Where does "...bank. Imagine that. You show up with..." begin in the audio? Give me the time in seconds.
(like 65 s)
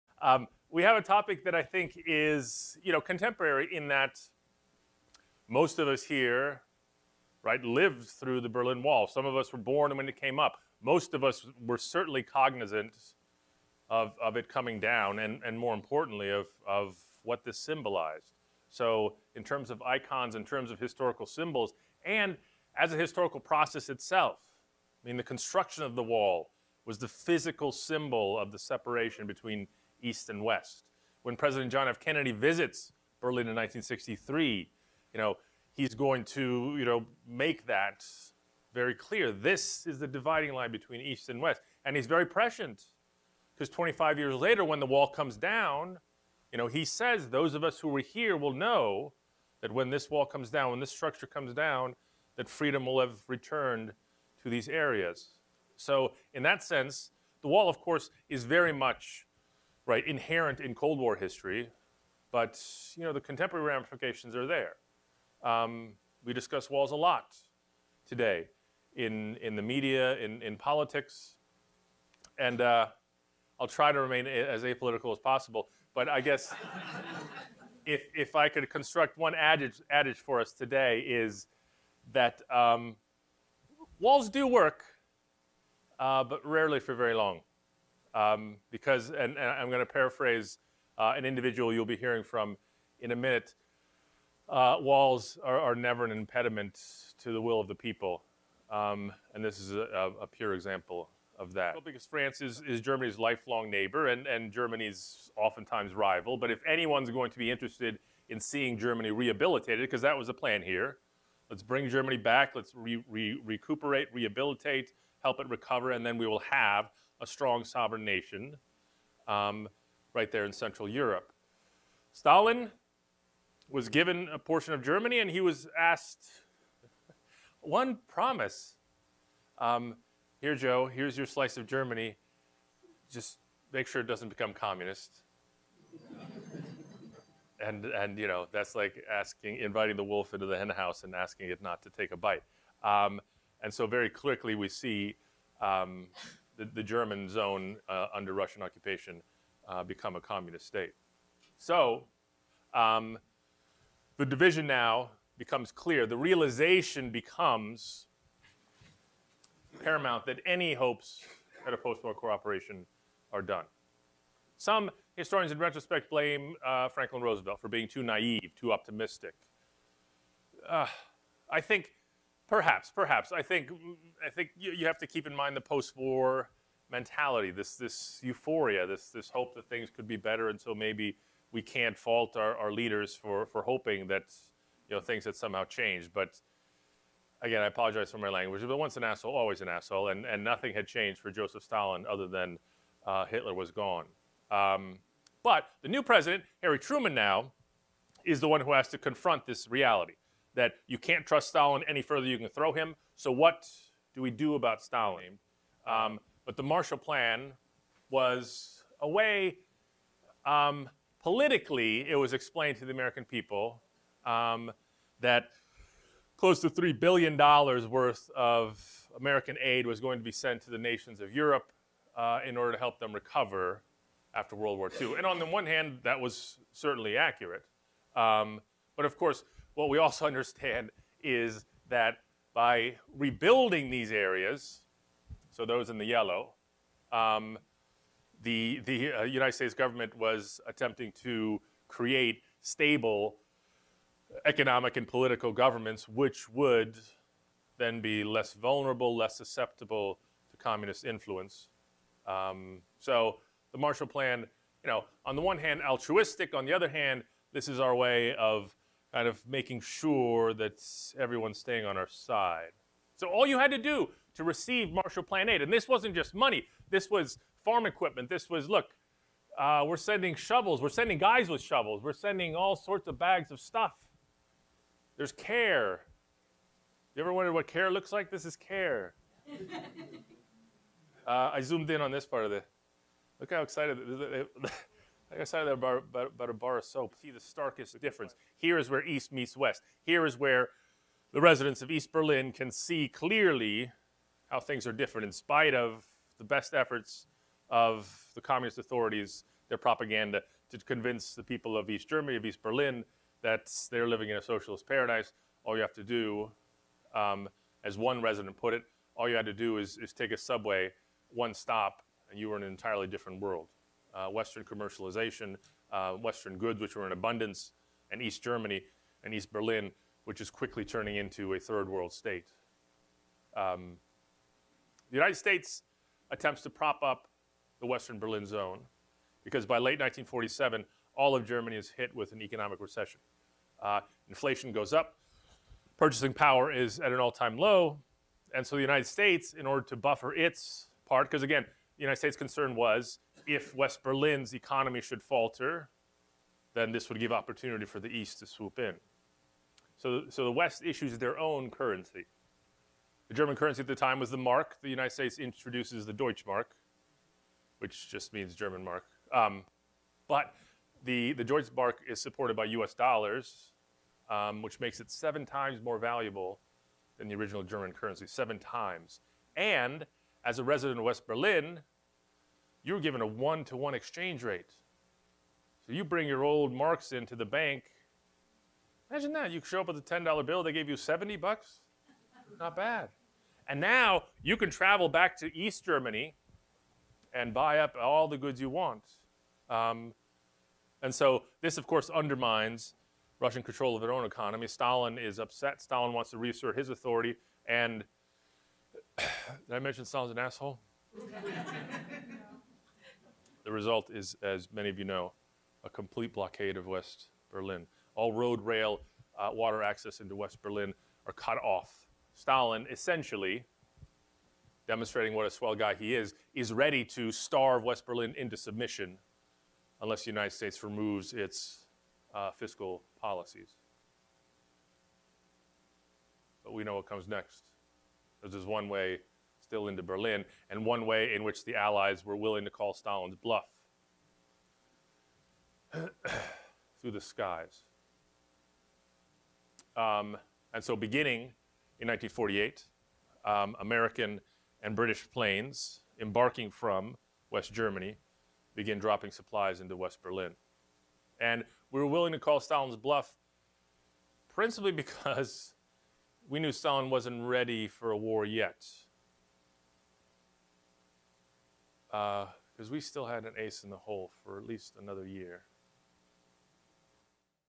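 377 s.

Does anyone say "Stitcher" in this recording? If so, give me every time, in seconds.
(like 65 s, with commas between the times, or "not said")
not said.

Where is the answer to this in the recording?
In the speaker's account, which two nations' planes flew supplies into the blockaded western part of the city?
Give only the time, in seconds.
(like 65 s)
443 s.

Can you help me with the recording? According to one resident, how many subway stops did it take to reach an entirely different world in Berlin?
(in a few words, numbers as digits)
1.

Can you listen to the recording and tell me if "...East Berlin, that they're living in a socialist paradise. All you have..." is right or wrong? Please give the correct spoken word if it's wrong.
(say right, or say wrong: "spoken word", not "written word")
right.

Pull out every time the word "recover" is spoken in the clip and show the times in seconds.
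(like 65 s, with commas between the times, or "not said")
115 s, 223 s.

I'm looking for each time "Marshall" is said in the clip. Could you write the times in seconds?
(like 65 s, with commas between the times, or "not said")
206 s, 253 s, 264 s.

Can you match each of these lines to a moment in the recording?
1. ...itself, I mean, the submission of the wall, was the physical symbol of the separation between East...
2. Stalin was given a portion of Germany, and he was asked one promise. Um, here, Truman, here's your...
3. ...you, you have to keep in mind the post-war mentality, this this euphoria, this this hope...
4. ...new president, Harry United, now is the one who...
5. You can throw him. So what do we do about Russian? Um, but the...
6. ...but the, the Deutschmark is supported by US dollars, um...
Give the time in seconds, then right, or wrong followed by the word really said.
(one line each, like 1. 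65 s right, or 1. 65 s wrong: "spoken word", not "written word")
1. 23 s wrong: "construction", not "submission"
2. 122 s wrong: "Joe", not "Truman"
3. 174 s right
4. 195 s wrong: "Truman", not "United"
5. 202 s wrong: "Stalin", not "Russian"
6. 360 s right.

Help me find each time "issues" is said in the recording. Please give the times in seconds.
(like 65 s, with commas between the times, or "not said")
350 s.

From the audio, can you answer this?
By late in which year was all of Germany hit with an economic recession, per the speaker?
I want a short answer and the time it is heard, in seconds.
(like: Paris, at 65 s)
1947, at 329 s.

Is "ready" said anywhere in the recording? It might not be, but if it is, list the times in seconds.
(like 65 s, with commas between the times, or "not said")
416 s, 457 s.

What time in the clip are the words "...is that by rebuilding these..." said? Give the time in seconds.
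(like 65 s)
231 s.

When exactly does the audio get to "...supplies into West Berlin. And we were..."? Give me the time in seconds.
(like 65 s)
449 s.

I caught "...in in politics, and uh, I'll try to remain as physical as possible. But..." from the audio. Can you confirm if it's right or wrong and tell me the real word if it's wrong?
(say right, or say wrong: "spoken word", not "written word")
wrong: "apolitical", not "physical".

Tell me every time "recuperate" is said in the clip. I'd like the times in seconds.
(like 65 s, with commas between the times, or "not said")
113 s.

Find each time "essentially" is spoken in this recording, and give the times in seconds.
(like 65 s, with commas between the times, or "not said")
412 s.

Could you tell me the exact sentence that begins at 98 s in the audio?
Um, and this is a, a, pure example of that.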